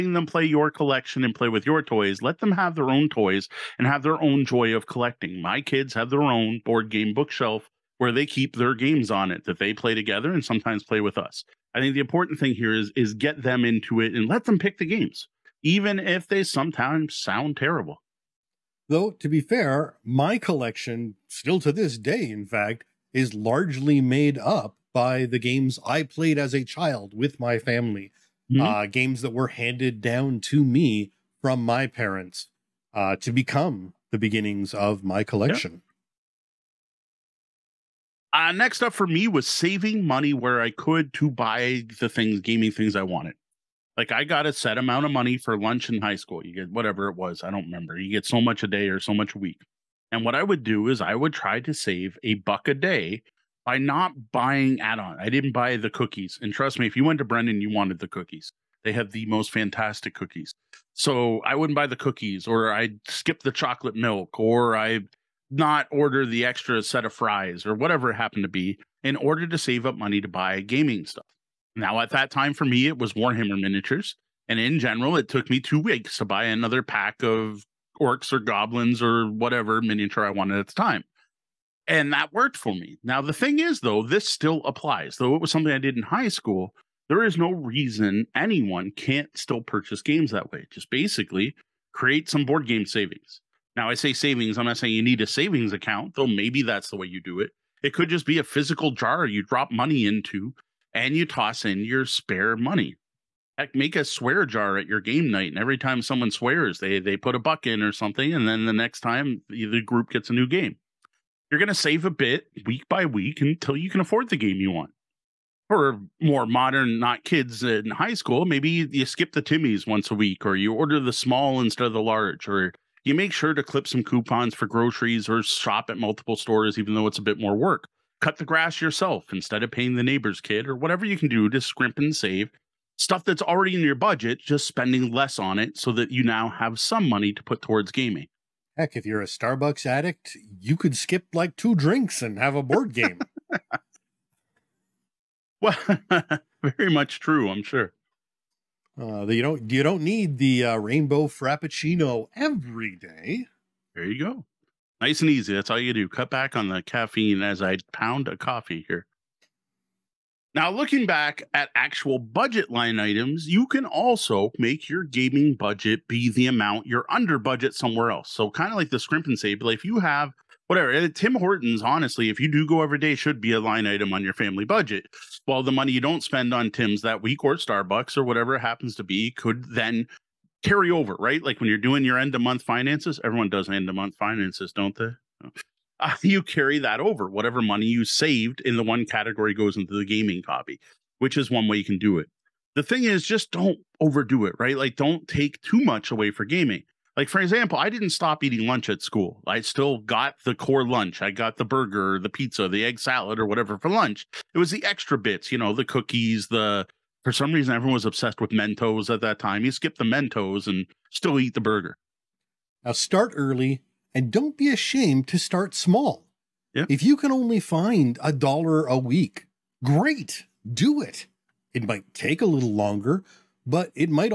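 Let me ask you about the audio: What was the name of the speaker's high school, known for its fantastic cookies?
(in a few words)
Brendan.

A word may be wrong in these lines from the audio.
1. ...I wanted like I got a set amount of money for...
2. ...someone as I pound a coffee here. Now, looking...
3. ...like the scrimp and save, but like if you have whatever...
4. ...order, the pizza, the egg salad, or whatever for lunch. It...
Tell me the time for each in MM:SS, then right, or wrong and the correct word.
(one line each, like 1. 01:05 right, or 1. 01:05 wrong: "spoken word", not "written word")
1. 00:42 right
2. 02:36 wrong: "caffeine", not "someone"
3. 02:48 right
4. 03:21 wrong: "burger", not "order".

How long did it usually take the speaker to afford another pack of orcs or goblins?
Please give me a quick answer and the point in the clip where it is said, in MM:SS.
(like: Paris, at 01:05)
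2 weeks, at 01:15.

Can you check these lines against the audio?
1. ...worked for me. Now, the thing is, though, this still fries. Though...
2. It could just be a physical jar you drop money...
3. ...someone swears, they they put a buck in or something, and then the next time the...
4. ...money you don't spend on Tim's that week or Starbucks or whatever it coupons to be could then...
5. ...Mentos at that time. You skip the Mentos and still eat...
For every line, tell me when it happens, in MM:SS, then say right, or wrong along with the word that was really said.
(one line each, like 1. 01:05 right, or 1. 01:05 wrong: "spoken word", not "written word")
1. 01:22 wrong: "applies", not "fries"
2. 01:37 right
3. 01:46 right
4. 02:55 wrong: "happens", not "coupons"
5. 03:28 right.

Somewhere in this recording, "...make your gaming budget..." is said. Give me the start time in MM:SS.
02:44.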